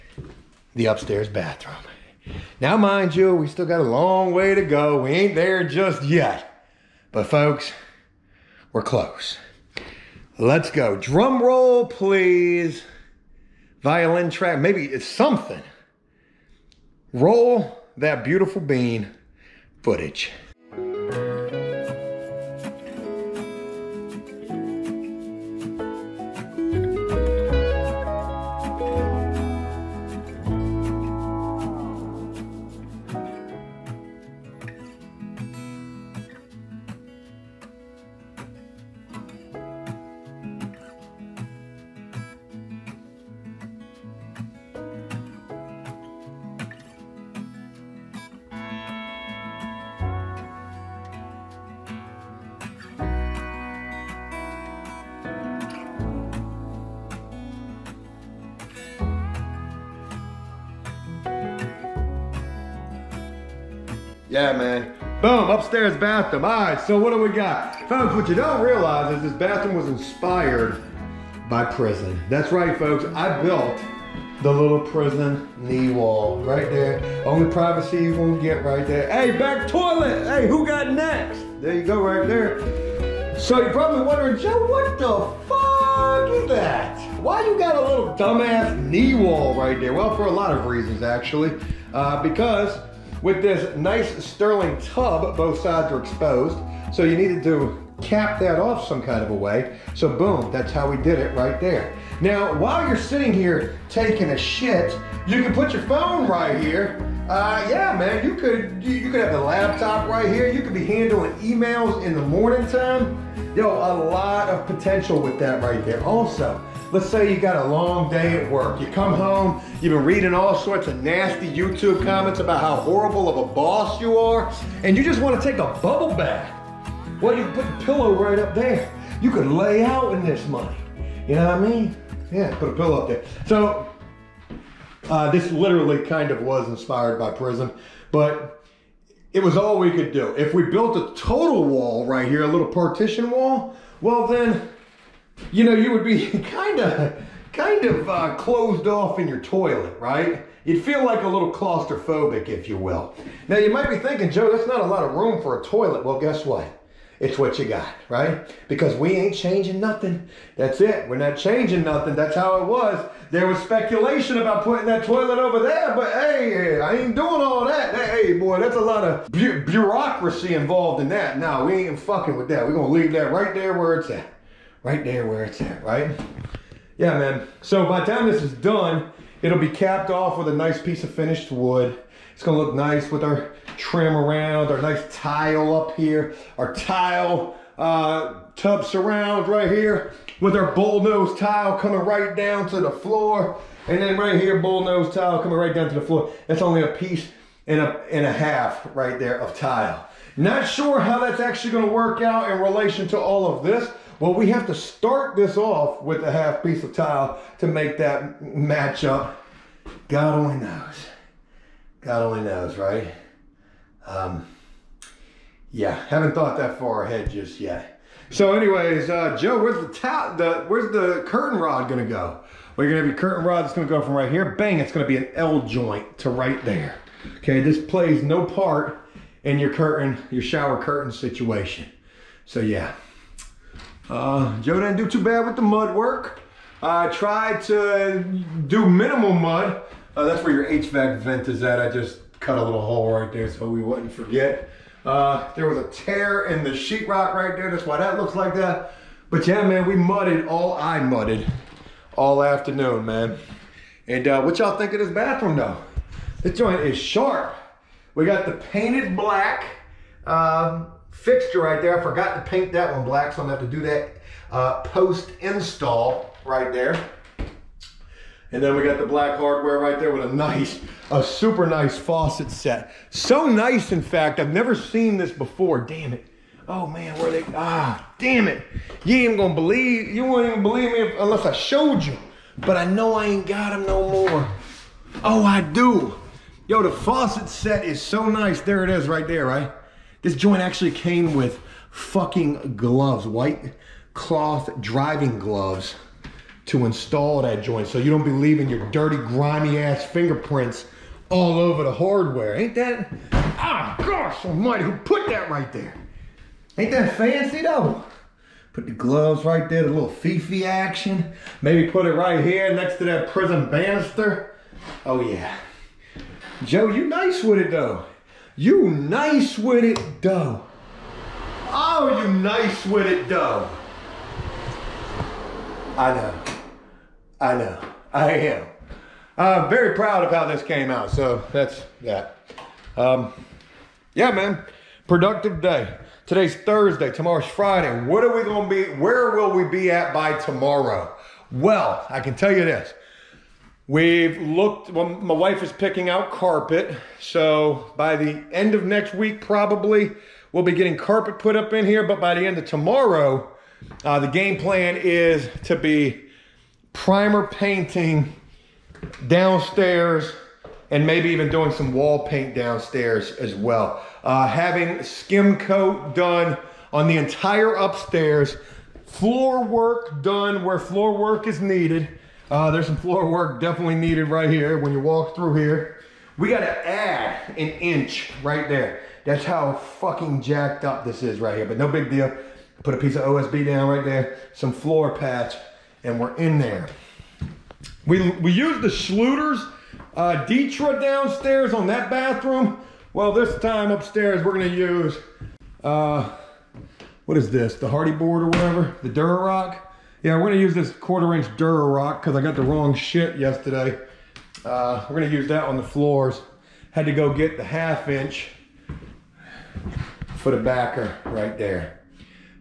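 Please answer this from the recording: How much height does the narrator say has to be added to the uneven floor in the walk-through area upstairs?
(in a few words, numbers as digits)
An inch.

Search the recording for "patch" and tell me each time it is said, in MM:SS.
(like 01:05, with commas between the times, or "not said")
06:25.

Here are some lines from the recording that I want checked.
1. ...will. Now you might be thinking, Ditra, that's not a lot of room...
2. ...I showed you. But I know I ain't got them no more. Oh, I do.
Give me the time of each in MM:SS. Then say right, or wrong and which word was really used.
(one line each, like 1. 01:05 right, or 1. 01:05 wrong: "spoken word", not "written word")
1. 02:32 wrong: "Joe", not "Ditra"
2. 04:41 right.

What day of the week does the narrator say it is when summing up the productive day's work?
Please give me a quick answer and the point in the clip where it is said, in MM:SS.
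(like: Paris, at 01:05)
Thursday, at 05:36.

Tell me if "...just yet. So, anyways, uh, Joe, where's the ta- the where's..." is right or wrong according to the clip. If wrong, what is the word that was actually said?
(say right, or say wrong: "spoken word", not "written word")
right.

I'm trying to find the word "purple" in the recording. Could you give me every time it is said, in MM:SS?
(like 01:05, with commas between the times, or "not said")
not said.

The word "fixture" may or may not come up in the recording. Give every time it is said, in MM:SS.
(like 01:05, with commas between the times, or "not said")
04:21.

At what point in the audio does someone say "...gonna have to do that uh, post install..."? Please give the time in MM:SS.
04:23.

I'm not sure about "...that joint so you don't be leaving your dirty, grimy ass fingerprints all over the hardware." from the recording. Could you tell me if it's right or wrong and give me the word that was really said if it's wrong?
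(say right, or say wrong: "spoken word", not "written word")
right.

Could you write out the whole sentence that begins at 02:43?
There was speculation about putting that toilet over there, but hey, I ain't doing all that.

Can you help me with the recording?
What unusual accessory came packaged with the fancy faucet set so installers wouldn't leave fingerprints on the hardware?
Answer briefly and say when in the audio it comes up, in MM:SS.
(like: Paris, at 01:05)
White cloth driving gloves, at 04:53.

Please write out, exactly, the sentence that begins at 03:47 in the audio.
Okay, this plays no part in your curtain, your shower curtain situation.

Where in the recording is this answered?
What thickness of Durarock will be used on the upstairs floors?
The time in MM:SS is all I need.
06:40.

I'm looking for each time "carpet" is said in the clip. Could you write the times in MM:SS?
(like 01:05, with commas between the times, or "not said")
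05:46, 05:50.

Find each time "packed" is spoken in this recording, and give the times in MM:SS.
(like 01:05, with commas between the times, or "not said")
not said.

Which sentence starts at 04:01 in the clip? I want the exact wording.
I just cut a little hole right there so we wouldn't forget.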